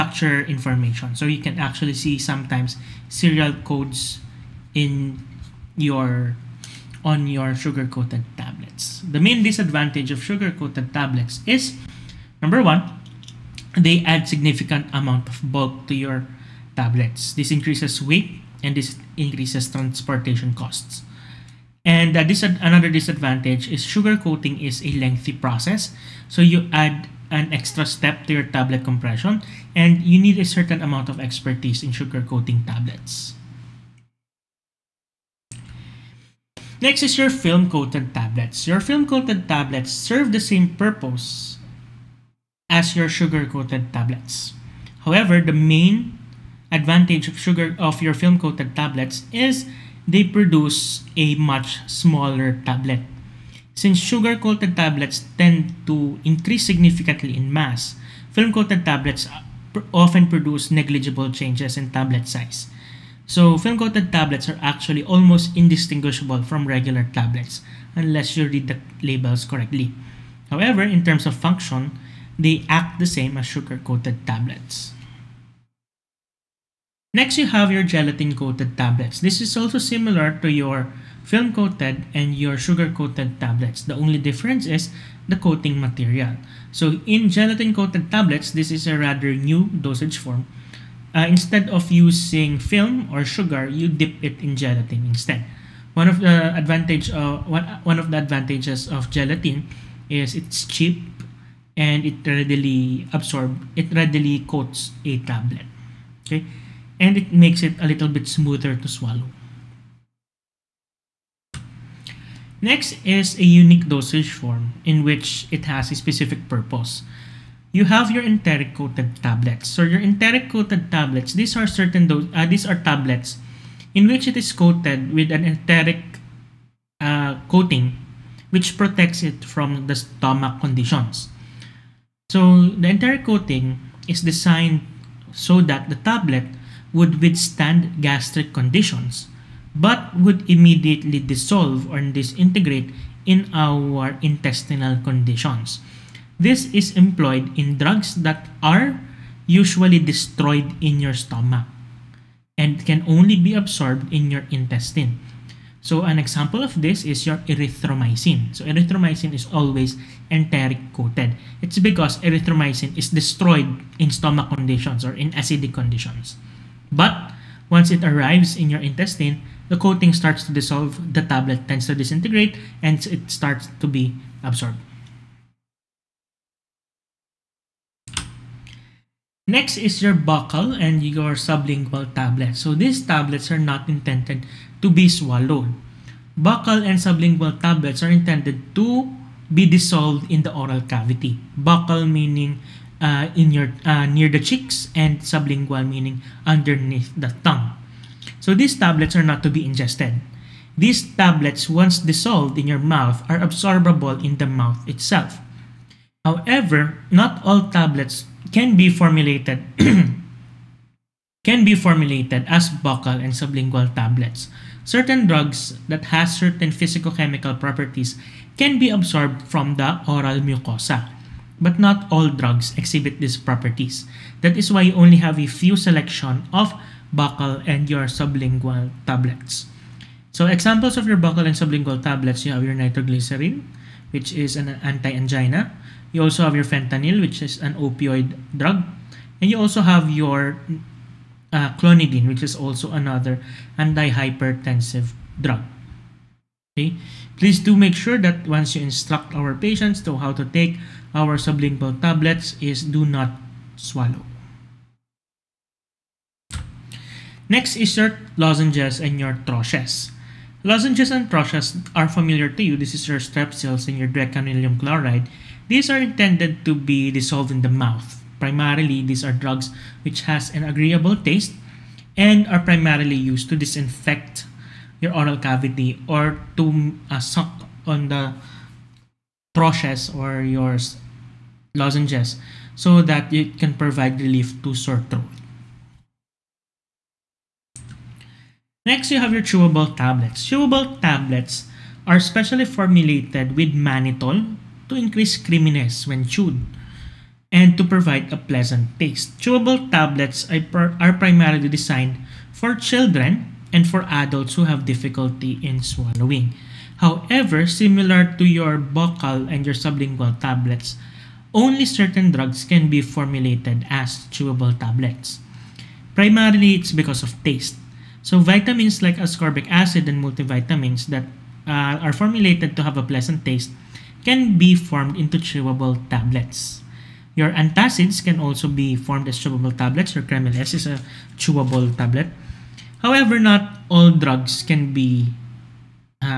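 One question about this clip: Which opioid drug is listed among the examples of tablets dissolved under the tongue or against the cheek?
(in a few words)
Fentanyl.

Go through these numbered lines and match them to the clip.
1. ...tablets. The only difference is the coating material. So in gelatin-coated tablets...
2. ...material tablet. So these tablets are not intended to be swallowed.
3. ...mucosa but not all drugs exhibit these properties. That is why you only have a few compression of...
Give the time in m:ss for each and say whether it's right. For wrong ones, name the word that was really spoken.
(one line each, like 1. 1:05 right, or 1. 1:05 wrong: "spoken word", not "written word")
1. 1:23 right
2. 3:01 wrong: "sublingual", not "material"
3. 3:40 wrong: "selection", not "compression".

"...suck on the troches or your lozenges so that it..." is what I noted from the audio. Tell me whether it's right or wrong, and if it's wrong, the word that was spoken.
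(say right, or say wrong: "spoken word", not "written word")
right.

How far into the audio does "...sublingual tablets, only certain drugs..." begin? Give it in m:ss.
5:09.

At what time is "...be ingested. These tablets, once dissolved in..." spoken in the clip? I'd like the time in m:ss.
3:19.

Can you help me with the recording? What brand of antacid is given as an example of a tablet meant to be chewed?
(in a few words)
Kremil.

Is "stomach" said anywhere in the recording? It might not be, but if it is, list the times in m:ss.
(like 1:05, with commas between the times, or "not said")
2:09, 2:31, 2:44.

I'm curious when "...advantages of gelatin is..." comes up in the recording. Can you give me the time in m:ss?
1:38.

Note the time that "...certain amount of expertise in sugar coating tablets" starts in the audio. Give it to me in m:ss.
0:30.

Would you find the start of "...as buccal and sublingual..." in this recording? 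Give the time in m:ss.
3:32.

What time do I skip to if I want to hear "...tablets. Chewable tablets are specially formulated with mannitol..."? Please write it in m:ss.
4:49.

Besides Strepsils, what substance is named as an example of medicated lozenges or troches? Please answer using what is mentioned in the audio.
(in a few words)
Dequalinium chloride.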